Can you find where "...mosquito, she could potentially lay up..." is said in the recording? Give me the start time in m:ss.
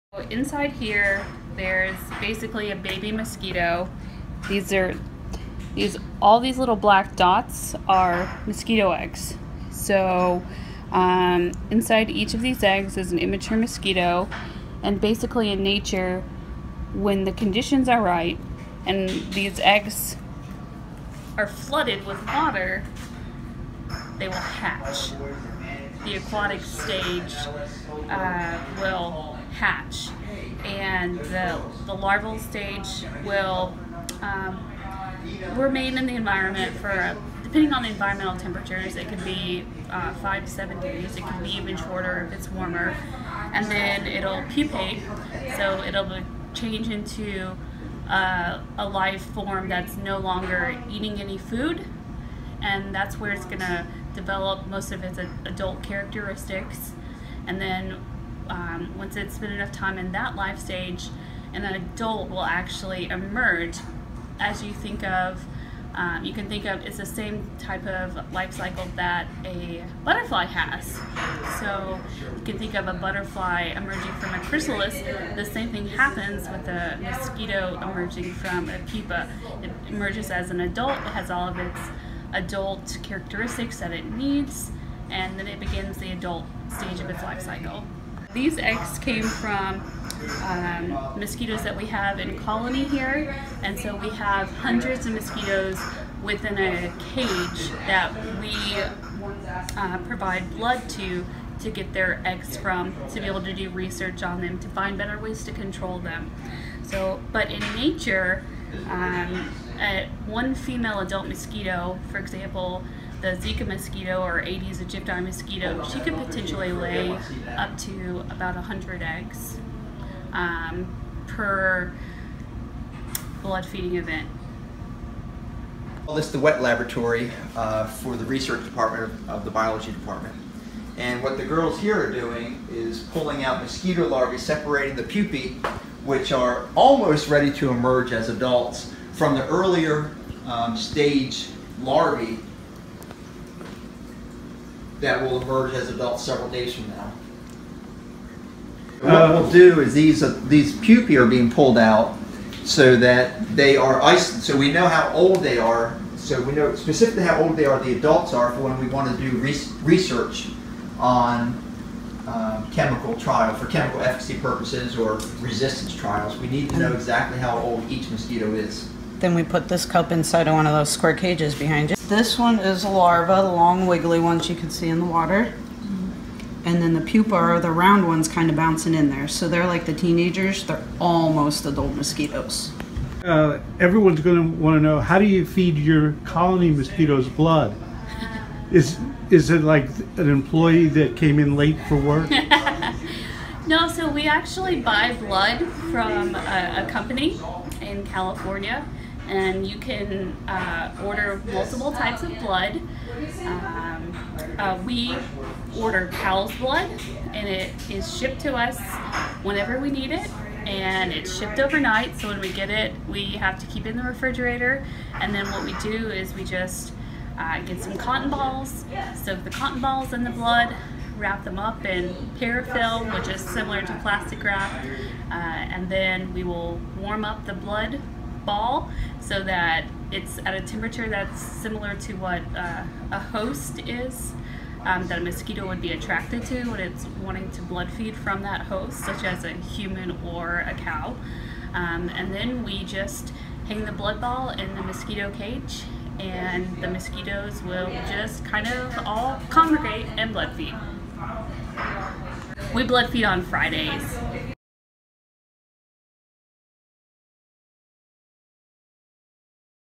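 1:55.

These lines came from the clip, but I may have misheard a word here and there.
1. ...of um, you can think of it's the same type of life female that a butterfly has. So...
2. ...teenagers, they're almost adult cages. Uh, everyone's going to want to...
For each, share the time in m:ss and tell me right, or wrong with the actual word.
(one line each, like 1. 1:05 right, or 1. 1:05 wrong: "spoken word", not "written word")
1. 1:05 wrong: "cycle", not "female"
2. 2:59 wrong: "mosquitoes", not "cages".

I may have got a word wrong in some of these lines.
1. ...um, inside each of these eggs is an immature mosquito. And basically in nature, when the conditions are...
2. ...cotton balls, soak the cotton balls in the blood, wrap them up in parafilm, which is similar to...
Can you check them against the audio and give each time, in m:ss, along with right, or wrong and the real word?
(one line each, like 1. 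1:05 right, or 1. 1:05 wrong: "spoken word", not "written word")
1. 0:10 right
2. 3:37 right.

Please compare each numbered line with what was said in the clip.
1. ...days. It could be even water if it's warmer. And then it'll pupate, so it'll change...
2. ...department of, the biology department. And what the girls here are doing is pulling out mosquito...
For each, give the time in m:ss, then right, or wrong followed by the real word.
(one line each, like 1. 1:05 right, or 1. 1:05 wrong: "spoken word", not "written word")
1. 0:40 wrong: "shorter", not "water"
2. 2:08 right.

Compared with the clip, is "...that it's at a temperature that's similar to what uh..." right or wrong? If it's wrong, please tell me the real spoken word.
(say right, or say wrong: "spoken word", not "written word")
right.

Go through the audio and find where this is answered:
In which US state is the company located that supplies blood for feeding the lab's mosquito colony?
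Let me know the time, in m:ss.
3:18.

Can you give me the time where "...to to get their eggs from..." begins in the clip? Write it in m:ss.
1:40.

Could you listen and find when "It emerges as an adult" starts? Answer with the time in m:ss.
1:19.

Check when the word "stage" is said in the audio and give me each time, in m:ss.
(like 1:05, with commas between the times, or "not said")
0:26, 0:32, 1:00, 1:26, 2:20.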